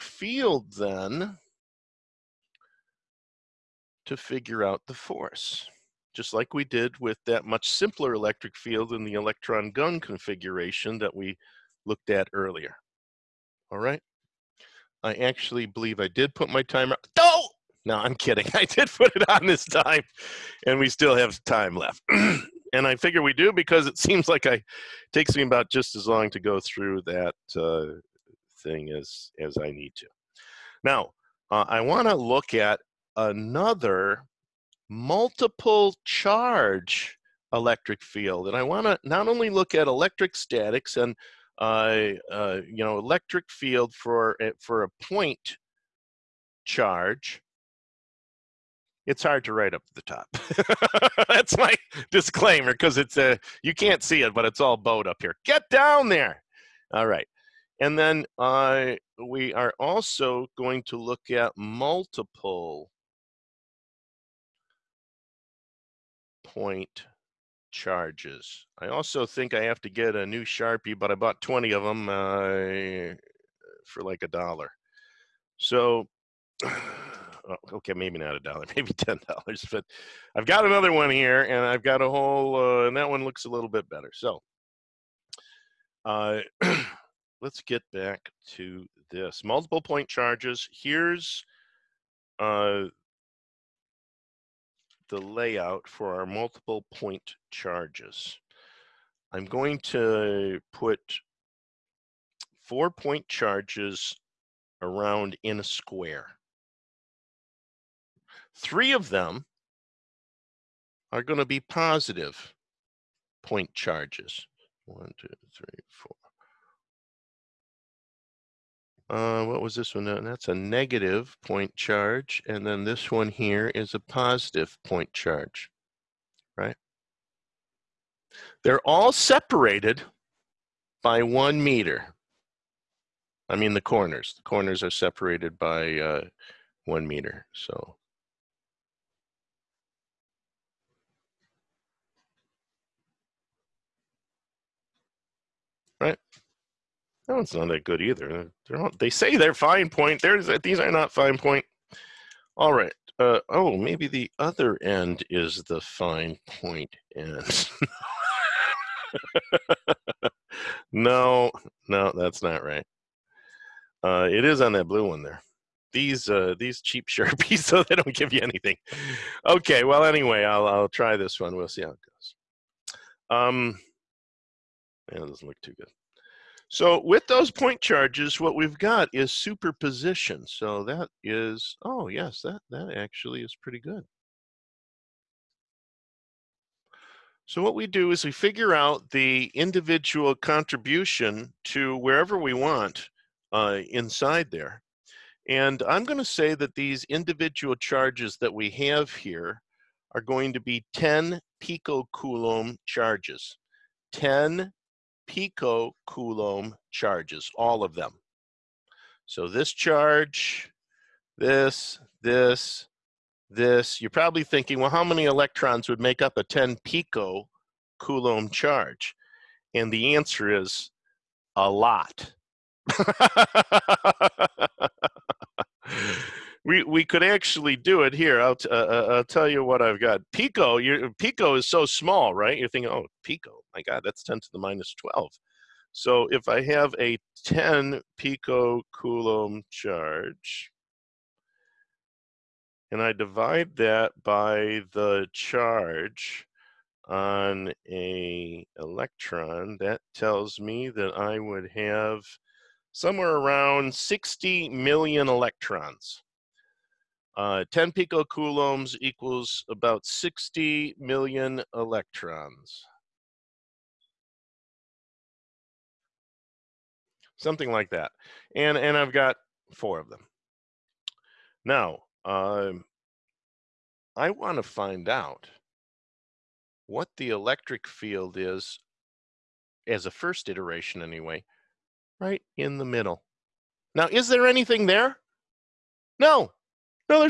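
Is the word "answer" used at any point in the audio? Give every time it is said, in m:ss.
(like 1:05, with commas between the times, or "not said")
3:40.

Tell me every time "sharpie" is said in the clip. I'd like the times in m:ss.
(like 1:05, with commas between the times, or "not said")
1:10, 2:47.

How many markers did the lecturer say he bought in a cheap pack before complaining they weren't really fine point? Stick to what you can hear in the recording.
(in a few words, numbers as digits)
20.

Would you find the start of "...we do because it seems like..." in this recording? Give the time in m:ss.
0:23.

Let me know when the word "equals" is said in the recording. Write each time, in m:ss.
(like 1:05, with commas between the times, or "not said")
4:19.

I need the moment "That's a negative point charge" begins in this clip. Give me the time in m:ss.
2:00.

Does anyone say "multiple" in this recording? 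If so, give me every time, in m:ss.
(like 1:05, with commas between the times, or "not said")
0:34, 1:01, 1:29, 1:36.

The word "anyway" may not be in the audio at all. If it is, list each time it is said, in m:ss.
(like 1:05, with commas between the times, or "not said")
2:50, 4:41.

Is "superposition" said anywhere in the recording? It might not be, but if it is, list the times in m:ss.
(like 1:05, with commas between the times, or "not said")
2:59.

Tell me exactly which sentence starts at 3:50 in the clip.
Pico, you Pico is so small, right?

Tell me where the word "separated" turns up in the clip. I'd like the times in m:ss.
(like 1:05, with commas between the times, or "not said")
2:09, 2:14.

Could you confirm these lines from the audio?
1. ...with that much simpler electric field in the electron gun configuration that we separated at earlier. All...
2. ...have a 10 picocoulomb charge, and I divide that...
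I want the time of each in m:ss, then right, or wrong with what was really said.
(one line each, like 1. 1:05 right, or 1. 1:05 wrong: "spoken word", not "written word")
1. 0:06 wrong: "looked", not "separated"
2. 3:56 right.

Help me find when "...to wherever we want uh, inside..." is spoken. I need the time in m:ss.
3:11.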